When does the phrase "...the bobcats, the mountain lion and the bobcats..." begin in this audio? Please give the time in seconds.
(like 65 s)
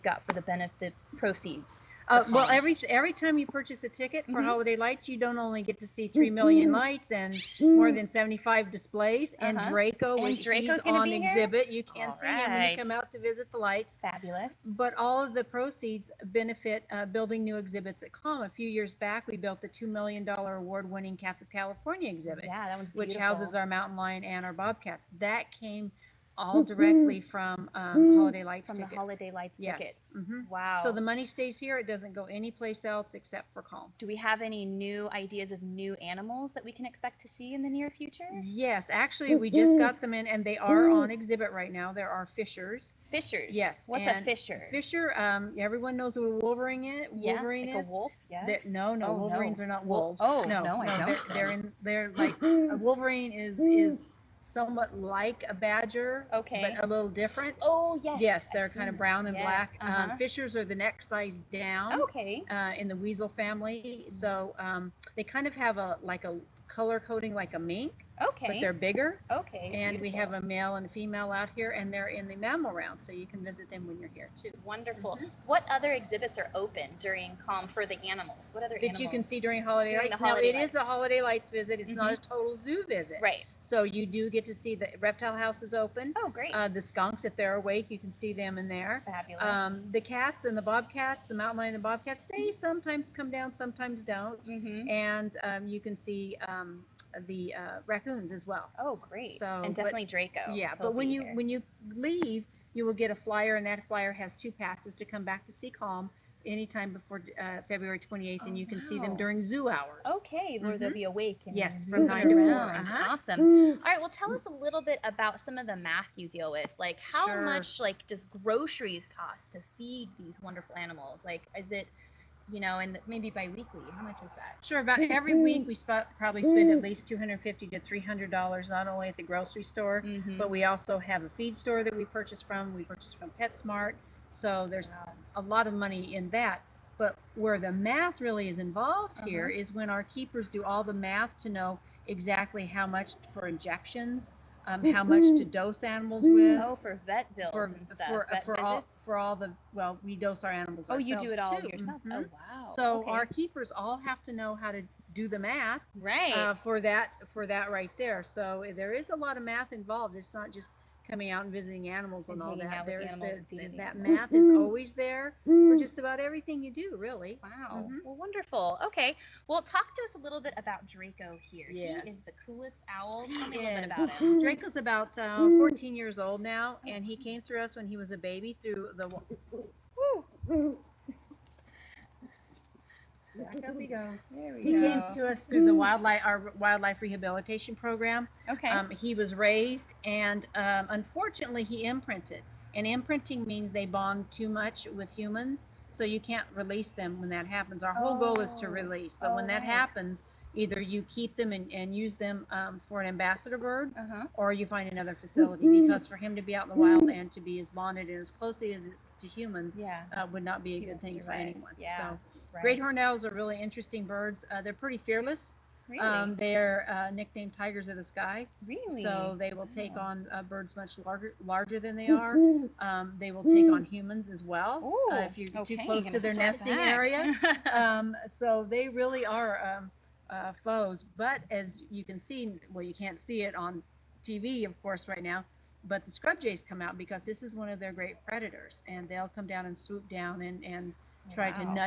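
90 s.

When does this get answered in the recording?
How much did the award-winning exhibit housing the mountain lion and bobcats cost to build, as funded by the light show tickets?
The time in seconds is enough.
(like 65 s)
19 s.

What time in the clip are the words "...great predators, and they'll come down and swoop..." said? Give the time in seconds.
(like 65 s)
237 s.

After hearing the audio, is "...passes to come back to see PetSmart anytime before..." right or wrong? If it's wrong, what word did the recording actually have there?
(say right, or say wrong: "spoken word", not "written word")
wrong: "CALM", not "PetSmart".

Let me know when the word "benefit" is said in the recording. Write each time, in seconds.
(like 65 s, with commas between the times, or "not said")
0 s, 16 s.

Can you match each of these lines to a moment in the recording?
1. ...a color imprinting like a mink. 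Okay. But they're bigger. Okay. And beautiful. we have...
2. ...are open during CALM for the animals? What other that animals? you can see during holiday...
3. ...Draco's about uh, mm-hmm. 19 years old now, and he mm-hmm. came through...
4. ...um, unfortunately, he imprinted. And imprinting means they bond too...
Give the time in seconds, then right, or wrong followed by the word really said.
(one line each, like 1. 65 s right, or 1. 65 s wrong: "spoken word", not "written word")
1. 66 s wrong: "coding", not "imprinting"
2. 76 s right
3. 174 s wrong: "14", not "19"
4. 190 s right.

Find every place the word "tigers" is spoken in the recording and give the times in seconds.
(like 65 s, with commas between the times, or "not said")
217 s.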